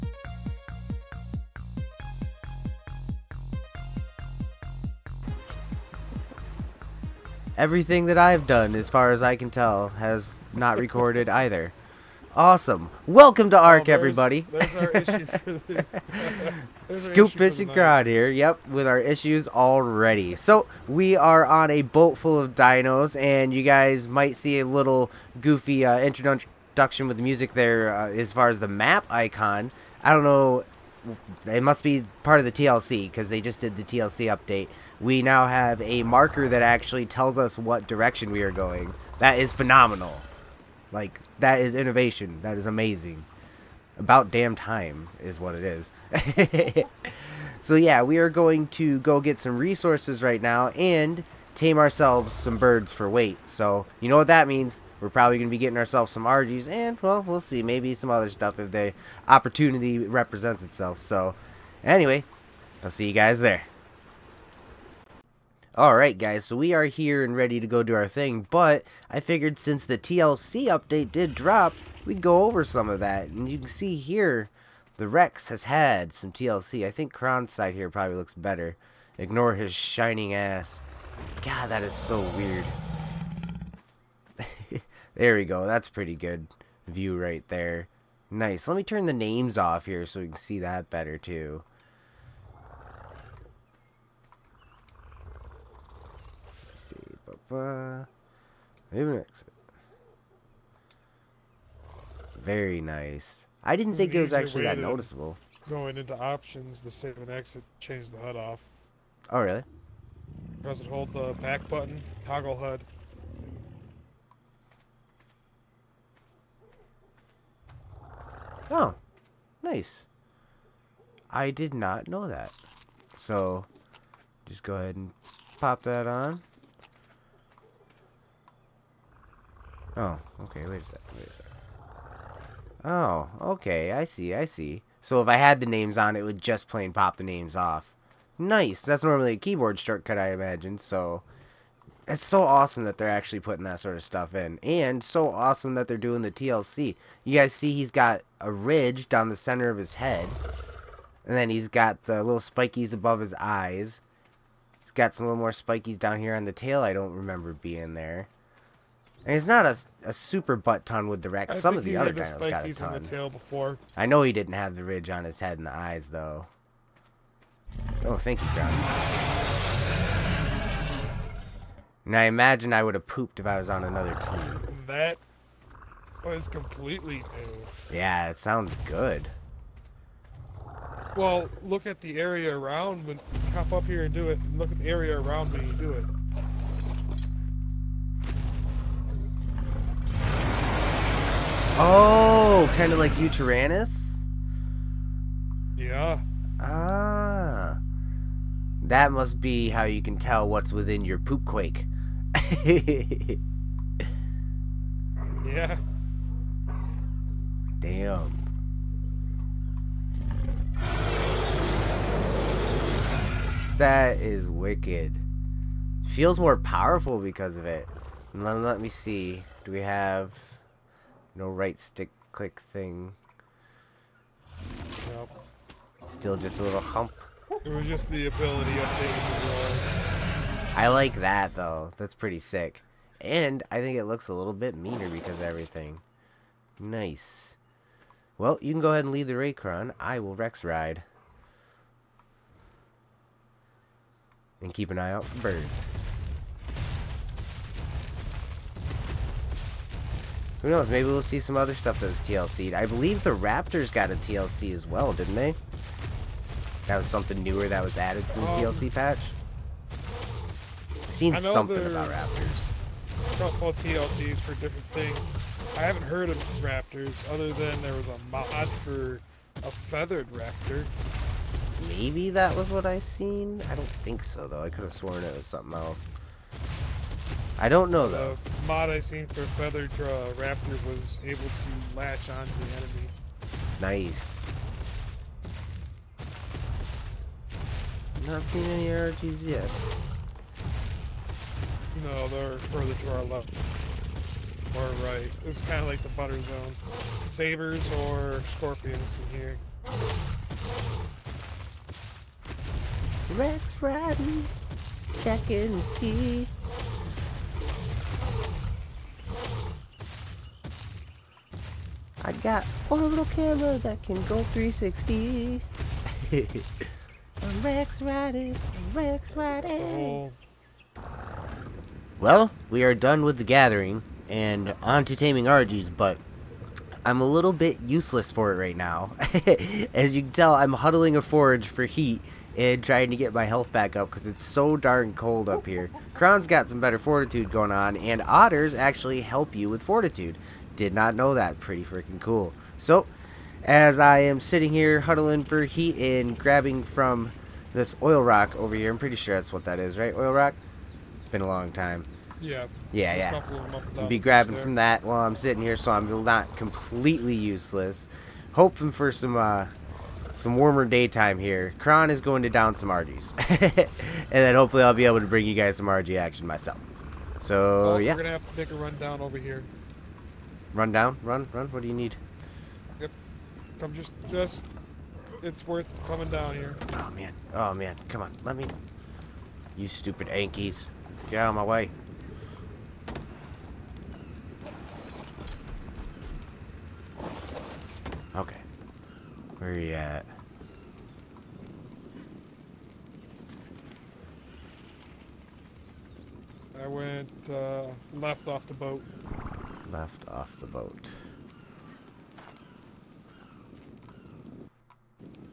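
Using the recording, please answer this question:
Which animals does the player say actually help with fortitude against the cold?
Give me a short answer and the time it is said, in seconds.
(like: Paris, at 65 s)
otters, at 338 s.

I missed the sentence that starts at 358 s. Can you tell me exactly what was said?
Hoping for some uh, some warmer daytime here.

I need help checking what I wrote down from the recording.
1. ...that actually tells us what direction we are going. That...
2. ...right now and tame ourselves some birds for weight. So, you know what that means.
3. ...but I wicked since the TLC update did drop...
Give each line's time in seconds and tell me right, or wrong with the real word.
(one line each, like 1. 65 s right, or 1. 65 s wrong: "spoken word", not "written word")
1. 36 s right
2. 50 s right
3. 68 s wrong: "figured", not "wicked".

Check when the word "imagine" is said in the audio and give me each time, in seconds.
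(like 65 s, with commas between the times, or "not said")
140 s, 172 s.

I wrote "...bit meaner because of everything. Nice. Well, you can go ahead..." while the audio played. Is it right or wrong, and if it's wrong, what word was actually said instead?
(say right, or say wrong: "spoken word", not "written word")
right.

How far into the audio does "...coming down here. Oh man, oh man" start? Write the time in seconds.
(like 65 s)
376 s.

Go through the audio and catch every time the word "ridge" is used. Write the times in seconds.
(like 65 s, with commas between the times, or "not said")
148 s, 164 s.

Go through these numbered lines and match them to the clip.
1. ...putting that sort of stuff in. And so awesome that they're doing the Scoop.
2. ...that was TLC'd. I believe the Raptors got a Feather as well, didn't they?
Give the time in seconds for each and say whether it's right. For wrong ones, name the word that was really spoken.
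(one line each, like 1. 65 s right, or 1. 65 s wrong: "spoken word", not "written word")
1. 143 s wrong: "TLC", not "Scoop"
2. 252 s wrong: "TLC", not "Feather".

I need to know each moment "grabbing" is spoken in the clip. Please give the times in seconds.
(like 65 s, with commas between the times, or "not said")
346 s, 354 s.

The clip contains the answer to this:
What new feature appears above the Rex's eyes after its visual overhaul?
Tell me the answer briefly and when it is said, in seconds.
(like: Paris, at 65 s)
little spikies, at 152 s.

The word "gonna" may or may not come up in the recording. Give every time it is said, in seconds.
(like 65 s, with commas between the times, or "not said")
368 s.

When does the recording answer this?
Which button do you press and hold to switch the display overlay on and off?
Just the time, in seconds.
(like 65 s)
111 s.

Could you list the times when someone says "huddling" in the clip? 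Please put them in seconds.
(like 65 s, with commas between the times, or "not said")
330 s, 345 s.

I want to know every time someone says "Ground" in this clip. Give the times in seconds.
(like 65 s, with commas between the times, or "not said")
168 s.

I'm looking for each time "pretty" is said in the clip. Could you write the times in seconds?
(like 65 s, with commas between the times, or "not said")
85 s, 232 s, 341 s, 348 s.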